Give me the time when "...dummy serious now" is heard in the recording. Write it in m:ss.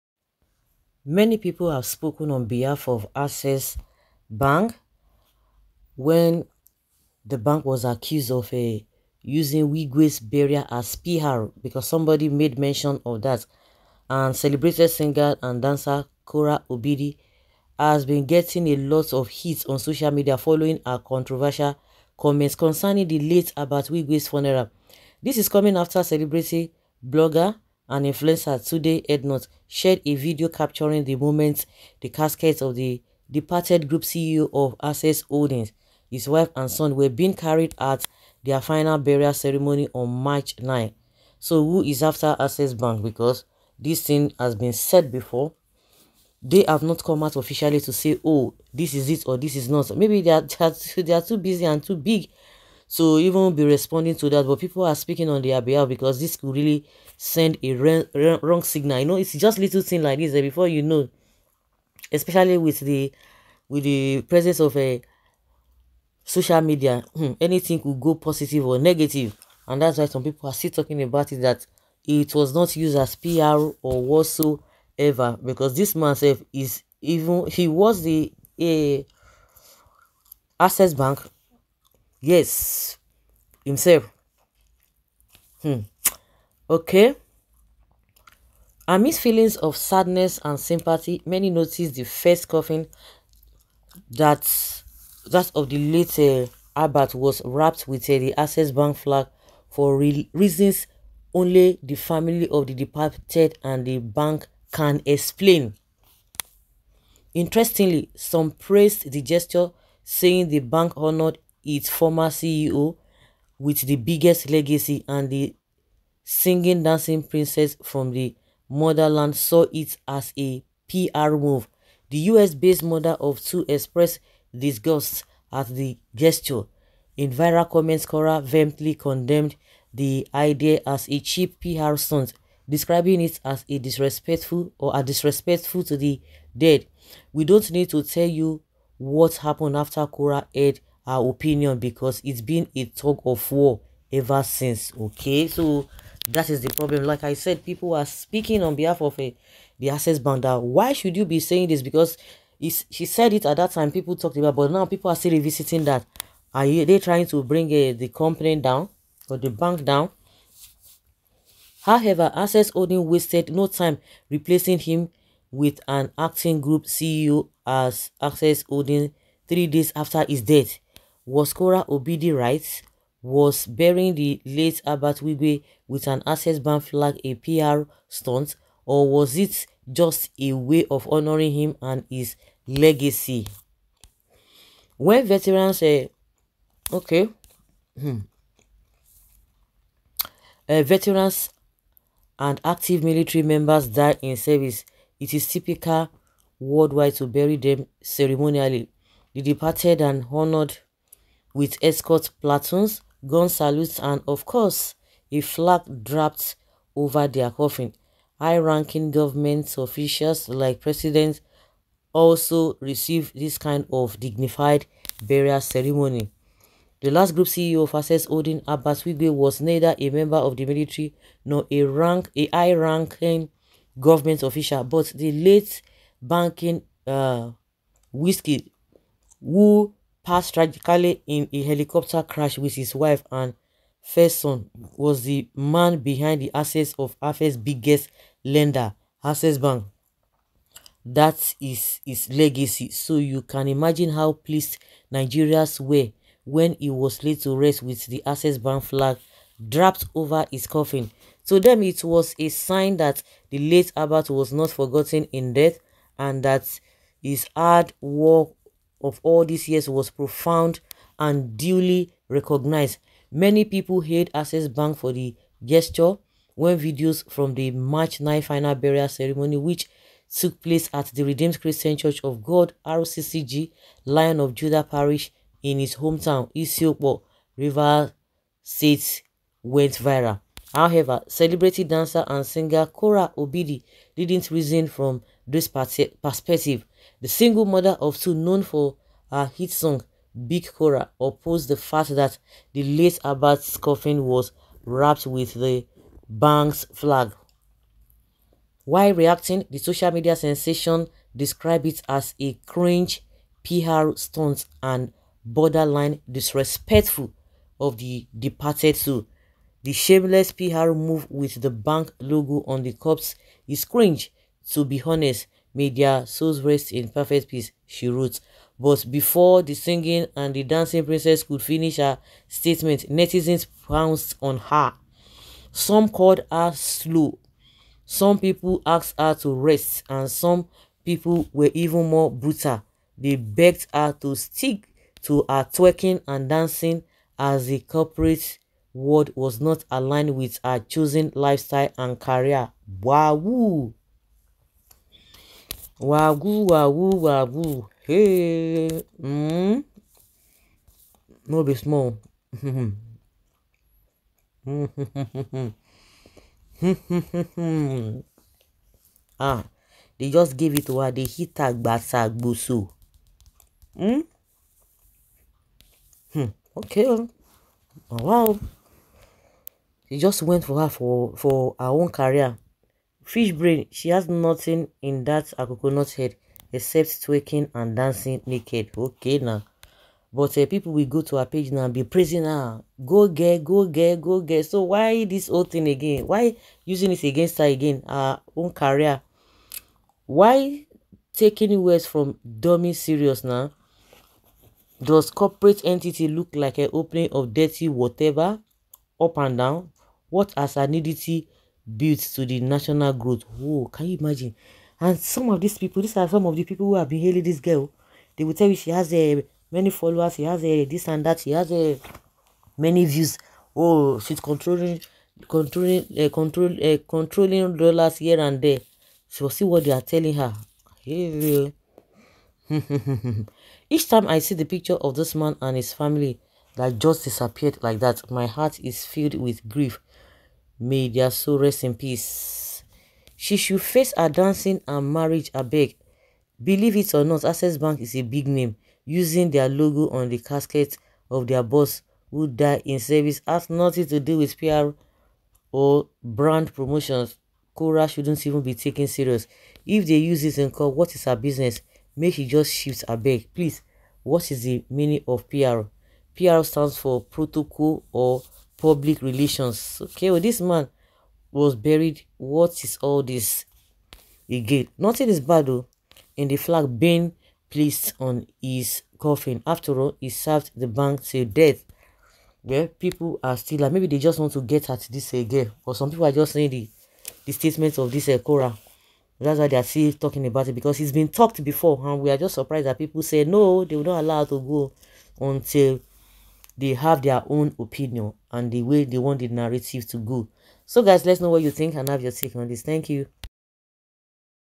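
6:32.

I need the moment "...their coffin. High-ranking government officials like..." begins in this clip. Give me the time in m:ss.
3:27.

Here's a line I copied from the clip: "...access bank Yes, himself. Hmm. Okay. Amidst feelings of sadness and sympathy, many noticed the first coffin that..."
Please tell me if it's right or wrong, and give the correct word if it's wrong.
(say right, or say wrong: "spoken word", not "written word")
right.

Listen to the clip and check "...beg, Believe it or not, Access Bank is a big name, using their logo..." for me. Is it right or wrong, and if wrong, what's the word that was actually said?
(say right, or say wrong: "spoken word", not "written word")
right.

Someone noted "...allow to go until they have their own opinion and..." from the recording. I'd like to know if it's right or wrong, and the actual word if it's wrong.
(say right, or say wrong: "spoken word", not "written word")
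right.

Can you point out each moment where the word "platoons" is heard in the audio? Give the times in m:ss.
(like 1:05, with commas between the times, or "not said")
3:22.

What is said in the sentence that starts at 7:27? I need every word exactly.
Korra shouldn't even be taken serious.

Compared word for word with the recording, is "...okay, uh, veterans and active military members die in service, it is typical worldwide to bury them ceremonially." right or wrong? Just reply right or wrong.
right.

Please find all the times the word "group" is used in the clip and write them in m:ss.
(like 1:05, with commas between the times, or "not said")
0:33, 2:46, 3:37.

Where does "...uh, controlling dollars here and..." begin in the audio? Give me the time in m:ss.
6:56.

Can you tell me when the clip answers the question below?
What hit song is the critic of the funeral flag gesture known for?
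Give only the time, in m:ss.
4:50.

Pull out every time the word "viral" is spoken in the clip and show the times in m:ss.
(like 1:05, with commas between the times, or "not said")
2:07, 4:39.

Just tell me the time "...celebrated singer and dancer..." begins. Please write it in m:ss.
0:14.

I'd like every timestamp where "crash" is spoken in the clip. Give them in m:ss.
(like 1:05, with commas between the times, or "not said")
3:52.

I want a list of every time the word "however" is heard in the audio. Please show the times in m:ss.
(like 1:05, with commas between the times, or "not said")
2:41, 4:40.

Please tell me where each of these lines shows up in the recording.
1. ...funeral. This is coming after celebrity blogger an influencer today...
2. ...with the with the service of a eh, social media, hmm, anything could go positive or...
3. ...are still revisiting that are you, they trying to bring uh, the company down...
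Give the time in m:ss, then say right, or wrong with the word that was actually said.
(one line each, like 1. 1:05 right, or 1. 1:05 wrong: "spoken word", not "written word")
1. 0:24 right
2. 1:02 wrong: "presence", not "service"
3. 2:35 right.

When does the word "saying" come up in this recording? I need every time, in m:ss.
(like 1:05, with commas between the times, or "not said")
1:50, 2:31, 7:56.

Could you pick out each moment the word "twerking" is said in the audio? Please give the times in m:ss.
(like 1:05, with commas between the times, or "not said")
5:35, 6:17.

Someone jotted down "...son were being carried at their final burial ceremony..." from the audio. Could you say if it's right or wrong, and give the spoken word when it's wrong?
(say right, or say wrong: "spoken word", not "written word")
right.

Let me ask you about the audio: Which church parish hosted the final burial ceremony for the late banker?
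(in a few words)
Lion of Judah Parish.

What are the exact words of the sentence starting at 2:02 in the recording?
The US-based mother of two expressed disgust at the gesture.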